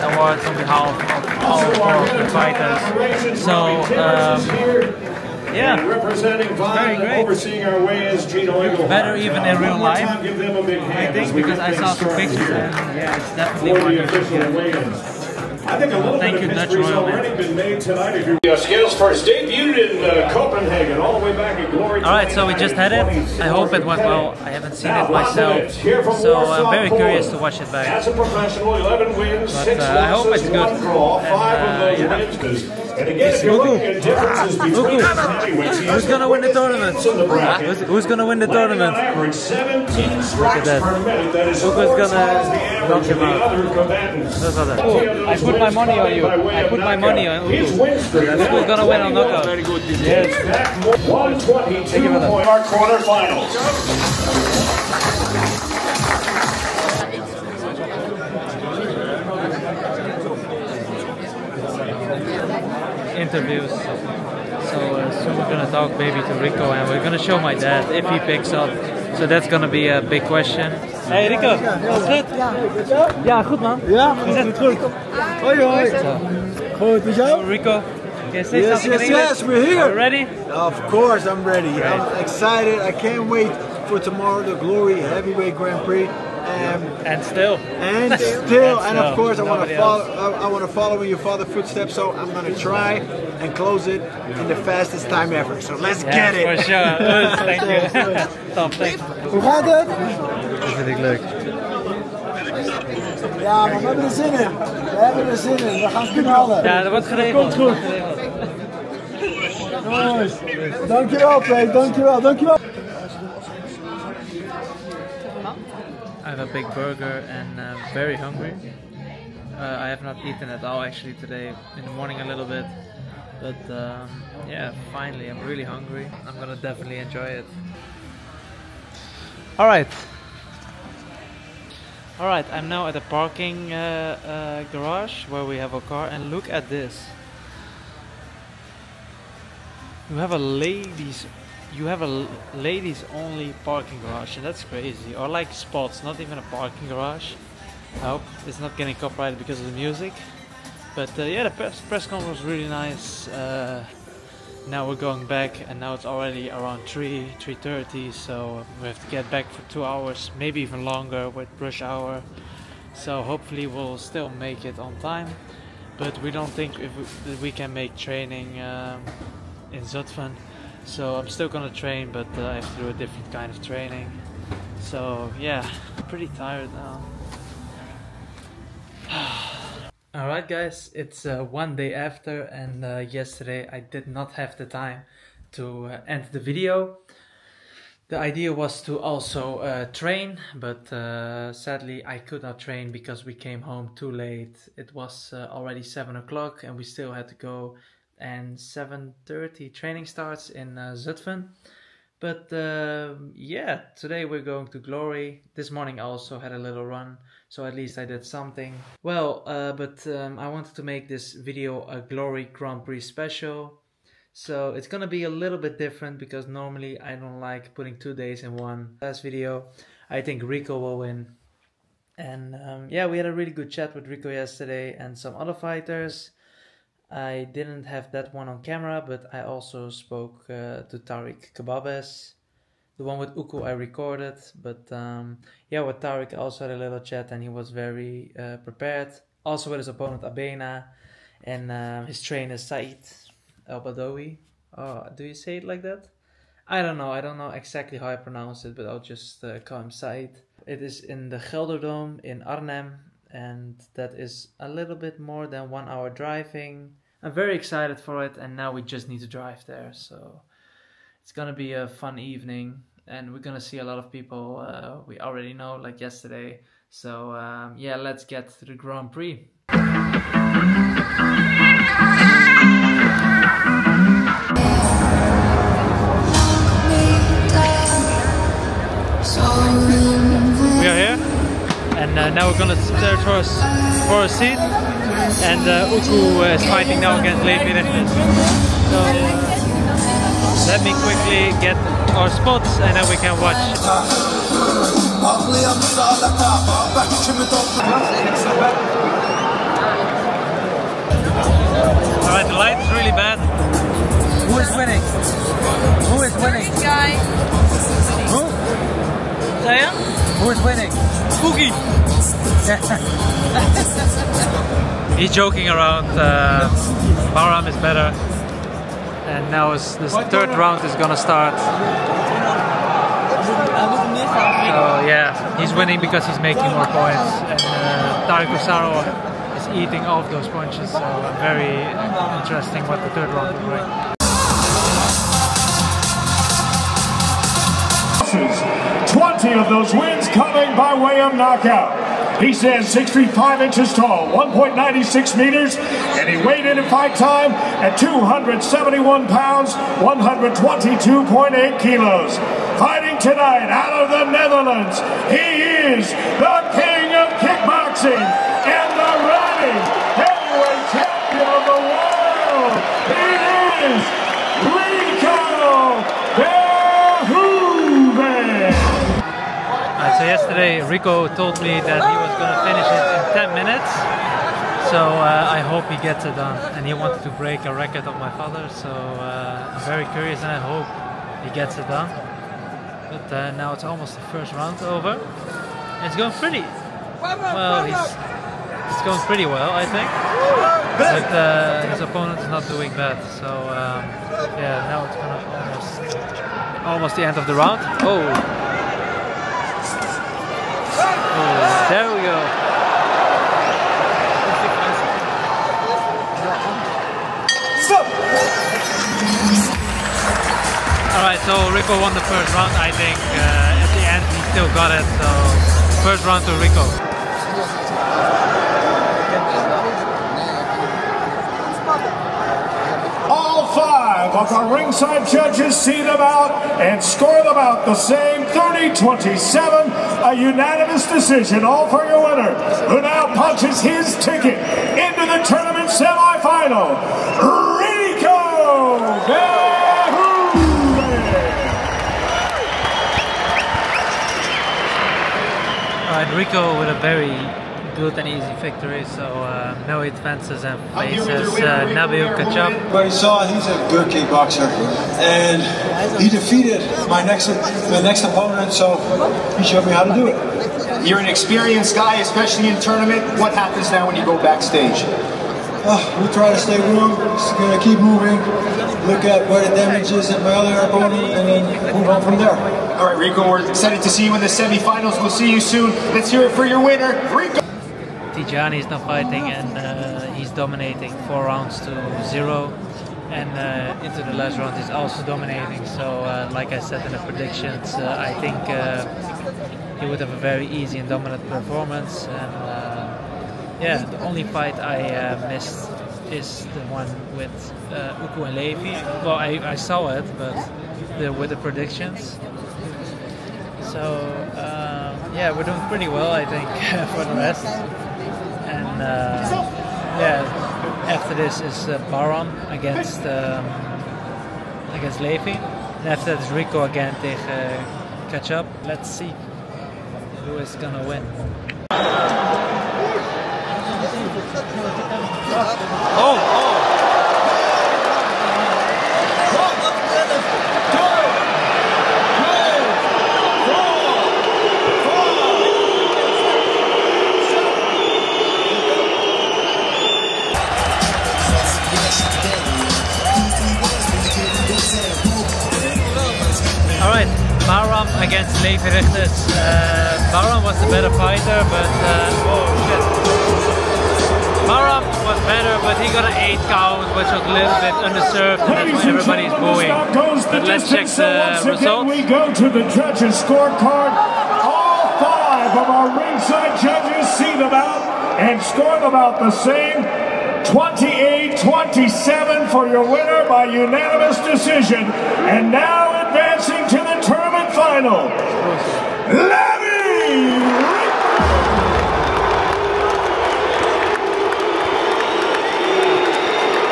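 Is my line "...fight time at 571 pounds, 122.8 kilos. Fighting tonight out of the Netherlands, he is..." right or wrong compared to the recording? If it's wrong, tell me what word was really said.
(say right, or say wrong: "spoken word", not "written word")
wrong: "271", not "571".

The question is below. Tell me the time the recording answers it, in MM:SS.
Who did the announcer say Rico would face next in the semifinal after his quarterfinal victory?
07:31.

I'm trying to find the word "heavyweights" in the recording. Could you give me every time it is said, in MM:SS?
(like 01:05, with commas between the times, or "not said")
00:34, 01:24.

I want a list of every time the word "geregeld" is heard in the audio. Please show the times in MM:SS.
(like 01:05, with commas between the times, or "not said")
01:47.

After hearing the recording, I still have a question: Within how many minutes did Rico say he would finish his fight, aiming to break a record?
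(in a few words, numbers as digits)
10.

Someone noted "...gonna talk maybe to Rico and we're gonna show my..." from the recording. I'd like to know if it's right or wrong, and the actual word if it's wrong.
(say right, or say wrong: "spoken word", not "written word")
right.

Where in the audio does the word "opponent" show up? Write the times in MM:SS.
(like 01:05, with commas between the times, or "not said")
03:59, 06:32, 07:38, 07:50.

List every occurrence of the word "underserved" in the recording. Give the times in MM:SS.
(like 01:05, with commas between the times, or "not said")
09:18.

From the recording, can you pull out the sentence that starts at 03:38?
Last video, I think Rico will win.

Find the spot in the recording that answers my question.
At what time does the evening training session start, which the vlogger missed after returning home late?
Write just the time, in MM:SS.
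03:18.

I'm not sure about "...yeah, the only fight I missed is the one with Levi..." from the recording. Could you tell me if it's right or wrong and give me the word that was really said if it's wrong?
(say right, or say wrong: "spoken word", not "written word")
wrong: "Uku", not "Levi".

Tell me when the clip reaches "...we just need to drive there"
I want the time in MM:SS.
04:18.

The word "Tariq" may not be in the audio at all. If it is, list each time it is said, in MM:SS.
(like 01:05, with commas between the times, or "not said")
03:51, 03:55.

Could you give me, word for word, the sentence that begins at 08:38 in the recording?
Let's see who is gonna win.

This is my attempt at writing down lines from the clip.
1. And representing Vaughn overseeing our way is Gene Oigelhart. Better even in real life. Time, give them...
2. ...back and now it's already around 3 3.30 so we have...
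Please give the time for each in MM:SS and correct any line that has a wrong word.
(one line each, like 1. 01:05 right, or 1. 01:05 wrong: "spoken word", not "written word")
1. 00:05 right
2. 02:35 right.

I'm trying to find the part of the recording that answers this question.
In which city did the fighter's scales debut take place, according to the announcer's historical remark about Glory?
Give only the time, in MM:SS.
00:20.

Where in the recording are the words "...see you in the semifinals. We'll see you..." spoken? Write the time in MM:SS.
07:54.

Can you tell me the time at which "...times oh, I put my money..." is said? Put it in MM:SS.
00:41.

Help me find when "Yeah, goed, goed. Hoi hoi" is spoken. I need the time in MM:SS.
01:13.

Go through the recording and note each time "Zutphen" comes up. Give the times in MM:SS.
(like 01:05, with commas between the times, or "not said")
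02:49, 03:20.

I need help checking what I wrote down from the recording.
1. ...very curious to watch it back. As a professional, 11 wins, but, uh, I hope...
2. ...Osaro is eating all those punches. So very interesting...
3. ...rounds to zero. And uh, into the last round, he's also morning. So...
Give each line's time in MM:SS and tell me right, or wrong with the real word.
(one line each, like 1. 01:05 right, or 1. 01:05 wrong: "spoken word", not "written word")
1. 00:26 right
2. 05:28 right
3. 08:01 wrong: "dominating", not "morning".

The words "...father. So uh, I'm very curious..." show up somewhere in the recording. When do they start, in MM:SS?
06:18.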